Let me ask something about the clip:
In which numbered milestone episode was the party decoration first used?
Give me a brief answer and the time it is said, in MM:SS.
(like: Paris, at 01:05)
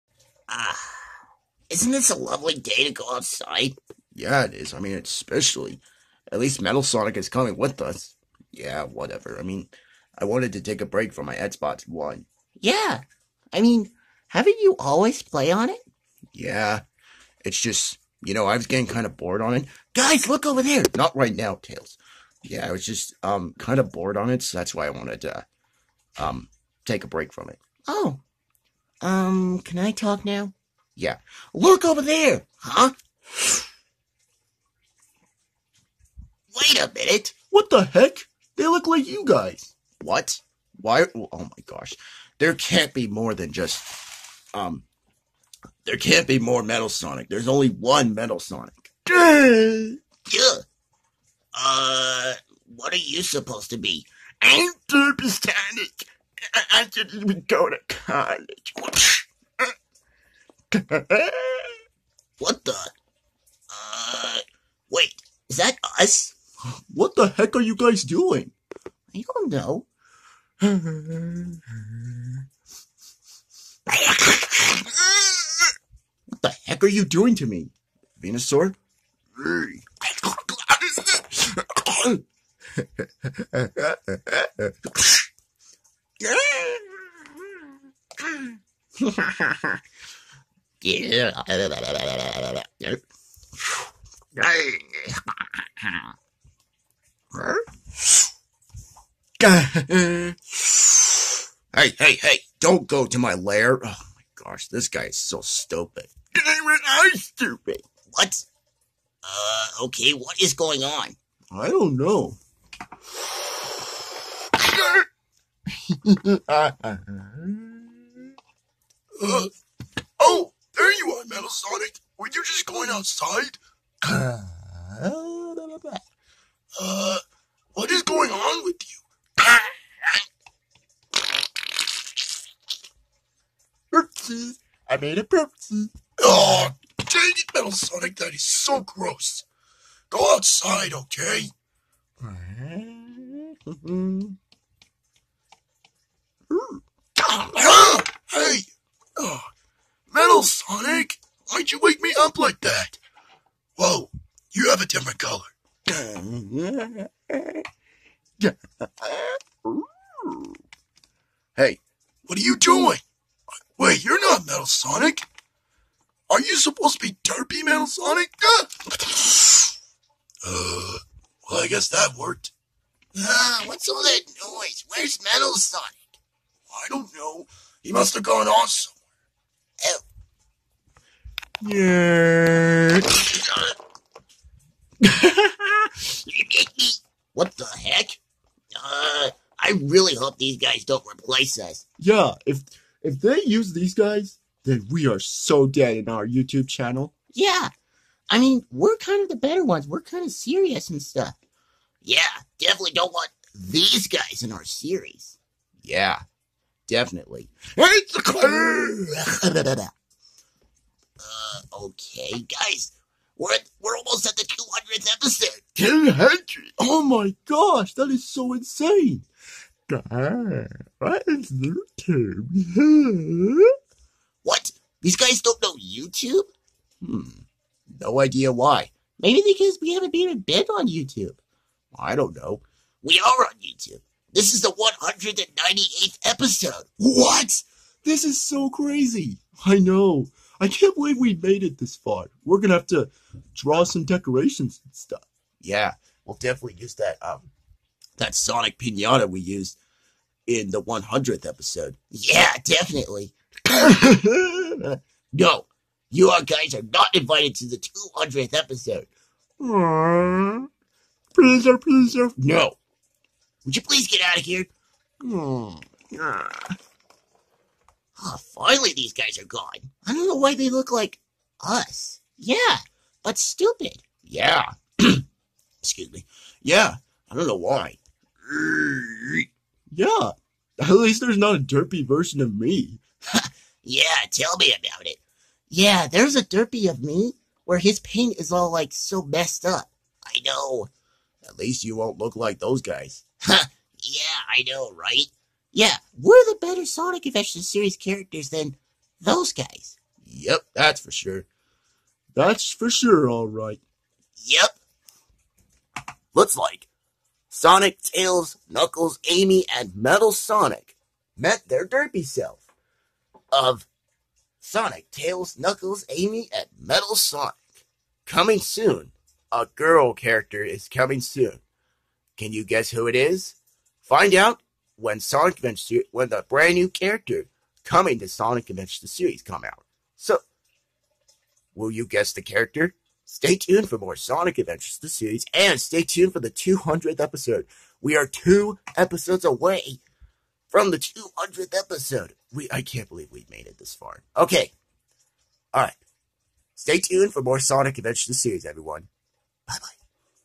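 100th, at 04:10.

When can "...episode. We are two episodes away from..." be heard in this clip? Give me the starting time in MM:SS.
05:37.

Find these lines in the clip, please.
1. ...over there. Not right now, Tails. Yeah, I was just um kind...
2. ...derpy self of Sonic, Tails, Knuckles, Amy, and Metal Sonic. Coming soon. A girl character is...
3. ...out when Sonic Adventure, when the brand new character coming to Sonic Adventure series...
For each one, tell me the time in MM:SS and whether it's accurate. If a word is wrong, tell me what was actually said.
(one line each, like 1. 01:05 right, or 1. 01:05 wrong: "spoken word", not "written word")
1. 00:20 right
2. 05:11 right
3. 05:24 right.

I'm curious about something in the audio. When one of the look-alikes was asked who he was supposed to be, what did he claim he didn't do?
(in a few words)
go to college.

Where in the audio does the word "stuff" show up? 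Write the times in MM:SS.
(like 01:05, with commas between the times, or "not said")
03:21, 04:04.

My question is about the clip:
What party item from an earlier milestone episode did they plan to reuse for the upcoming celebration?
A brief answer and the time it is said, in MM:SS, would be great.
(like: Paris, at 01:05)
Sonic Pinata, at 04:08.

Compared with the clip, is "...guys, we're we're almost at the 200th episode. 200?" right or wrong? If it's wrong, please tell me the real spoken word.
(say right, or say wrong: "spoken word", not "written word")
right.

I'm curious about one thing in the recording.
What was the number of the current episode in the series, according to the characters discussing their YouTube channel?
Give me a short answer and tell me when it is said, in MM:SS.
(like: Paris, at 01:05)
198th, at 03:55.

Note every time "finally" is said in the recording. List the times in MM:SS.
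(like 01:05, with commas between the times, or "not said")
04:28.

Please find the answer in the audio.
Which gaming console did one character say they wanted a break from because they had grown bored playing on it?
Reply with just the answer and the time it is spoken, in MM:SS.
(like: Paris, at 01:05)
Xbox One, at 00:11.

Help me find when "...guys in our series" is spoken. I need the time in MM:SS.
03:24.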